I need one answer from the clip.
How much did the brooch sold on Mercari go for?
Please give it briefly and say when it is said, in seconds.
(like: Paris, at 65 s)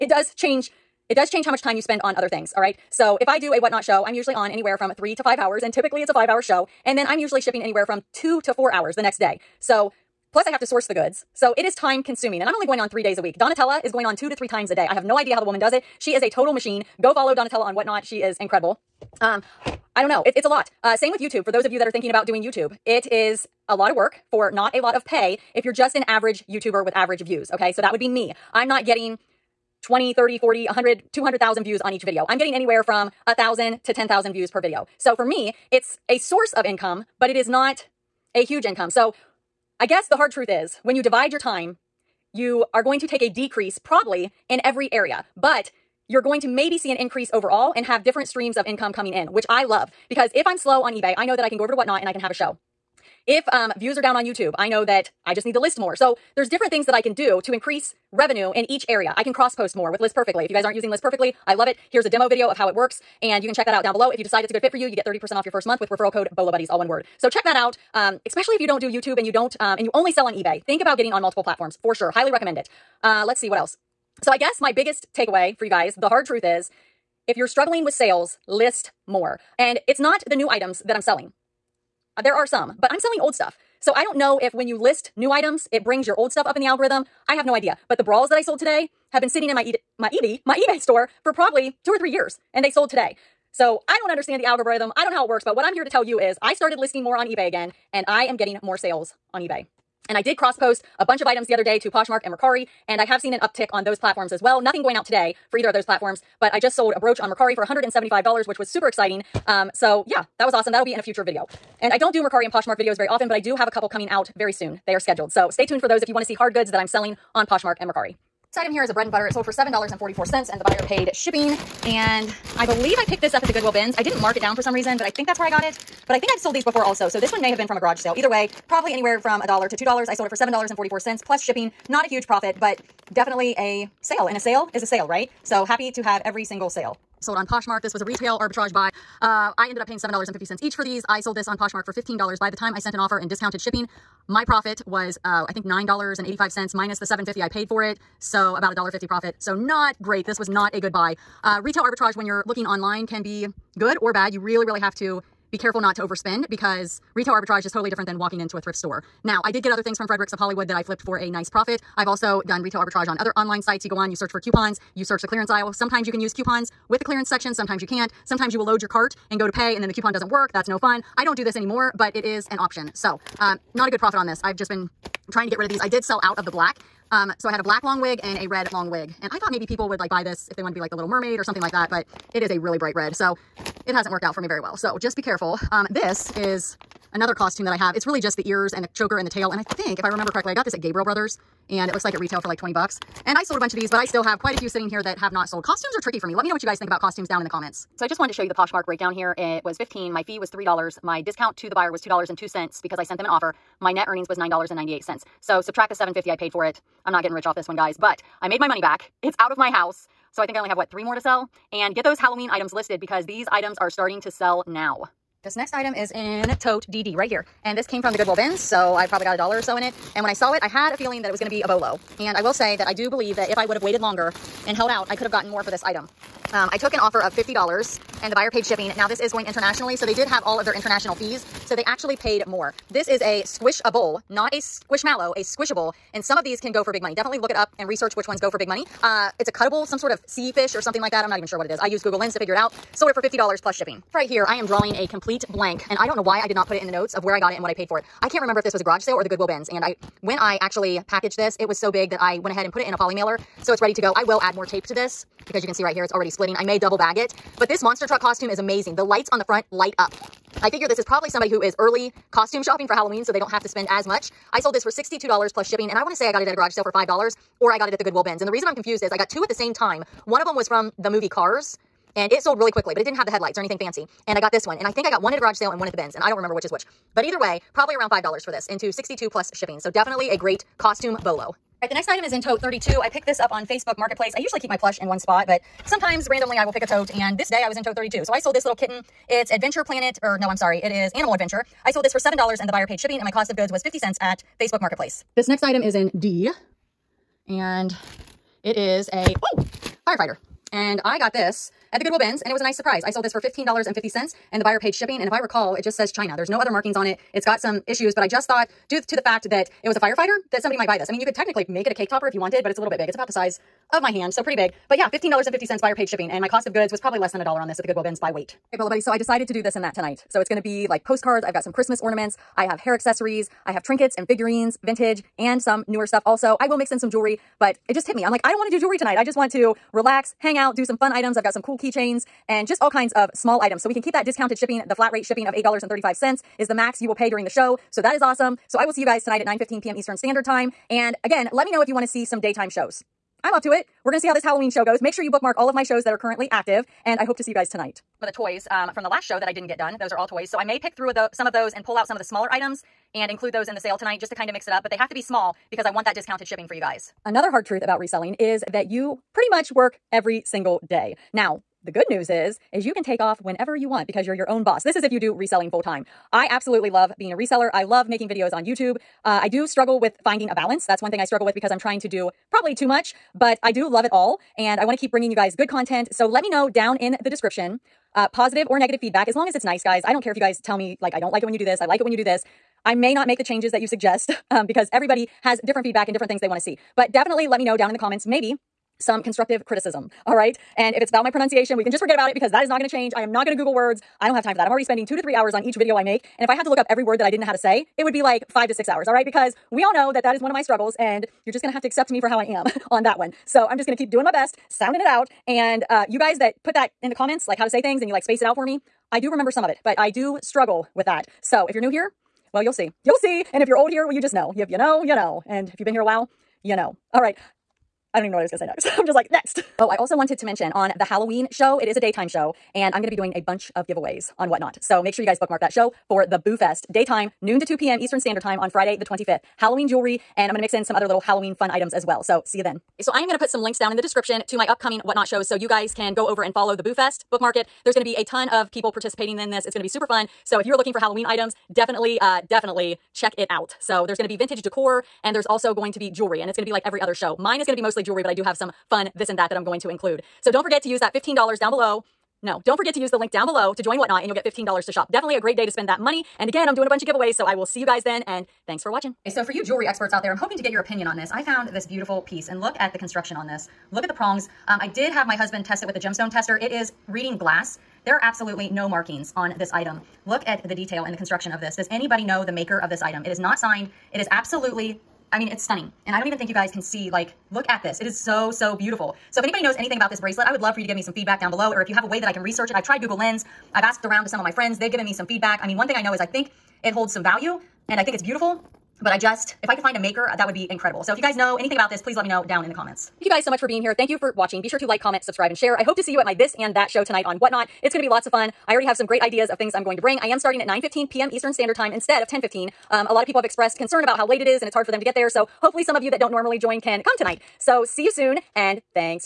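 $175, at 107 s.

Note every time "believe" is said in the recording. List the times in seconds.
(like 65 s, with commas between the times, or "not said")
122 s, 223 s.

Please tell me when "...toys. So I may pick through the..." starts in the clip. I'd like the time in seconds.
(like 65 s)
350 s.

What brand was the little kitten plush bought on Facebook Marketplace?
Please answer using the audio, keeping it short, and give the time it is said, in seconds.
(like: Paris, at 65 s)
Animal Adventure, at 291 s.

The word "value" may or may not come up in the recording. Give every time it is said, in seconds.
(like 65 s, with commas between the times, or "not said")
487 s.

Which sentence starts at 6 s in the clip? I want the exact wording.
And then I'm usually shipping anywhere from two to four hours the next day.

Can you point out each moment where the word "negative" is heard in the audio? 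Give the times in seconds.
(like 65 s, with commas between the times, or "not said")
378 s.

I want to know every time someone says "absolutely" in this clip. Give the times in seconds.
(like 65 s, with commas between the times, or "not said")
366 s, 468 s, 474 s.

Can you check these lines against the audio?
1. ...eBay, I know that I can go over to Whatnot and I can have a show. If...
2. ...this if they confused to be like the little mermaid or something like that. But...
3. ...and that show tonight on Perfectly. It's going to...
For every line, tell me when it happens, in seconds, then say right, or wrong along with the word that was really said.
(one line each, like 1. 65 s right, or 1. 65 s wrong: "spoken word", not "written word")
1. 50 s right
2. 180 s wrong: "wanted", not "confused"
3. 496 s wrong: "Whatnot", not "Perfectly".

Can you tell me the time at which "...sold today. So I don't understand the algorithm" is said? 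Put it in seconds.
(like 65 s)
92 s.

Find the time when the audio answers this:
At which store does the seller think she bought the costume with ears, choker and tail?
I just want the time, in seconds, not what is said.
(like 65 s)
190 s.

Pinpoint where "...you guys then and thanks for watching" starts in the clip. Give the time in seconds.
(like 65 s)
457 s.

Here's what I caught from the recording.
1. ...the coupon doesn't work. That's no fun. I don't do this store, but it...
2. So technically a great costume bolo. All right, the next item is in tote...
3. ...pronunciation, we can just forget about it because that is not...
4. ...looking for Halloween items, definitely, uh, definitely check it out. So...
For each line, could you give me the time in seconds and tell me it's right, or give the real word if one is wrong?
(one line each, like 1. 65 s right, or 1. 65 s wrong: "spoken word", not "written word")
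1. 169 s wrong: "anymore", not "store"
2. 279 s wrong: "definitely", not "technically"
3. 391 s right
4. 440 s right.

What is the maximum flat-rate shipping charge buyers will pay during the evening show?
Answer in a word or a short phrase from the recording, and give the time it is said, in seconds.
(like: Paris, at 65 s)
$8.35, at 335 s.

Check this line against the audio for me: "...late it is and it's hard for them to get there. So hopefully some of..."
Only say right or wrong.
right.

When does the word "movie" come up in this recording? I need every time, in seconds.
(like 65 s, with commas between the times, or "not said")
271 s.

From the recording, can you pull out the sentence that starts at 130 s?
I sold it for $7.44 plus shipping.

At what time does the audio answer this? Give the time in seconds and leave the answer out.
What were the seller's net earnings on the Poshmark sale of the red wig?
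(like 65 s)
204 s.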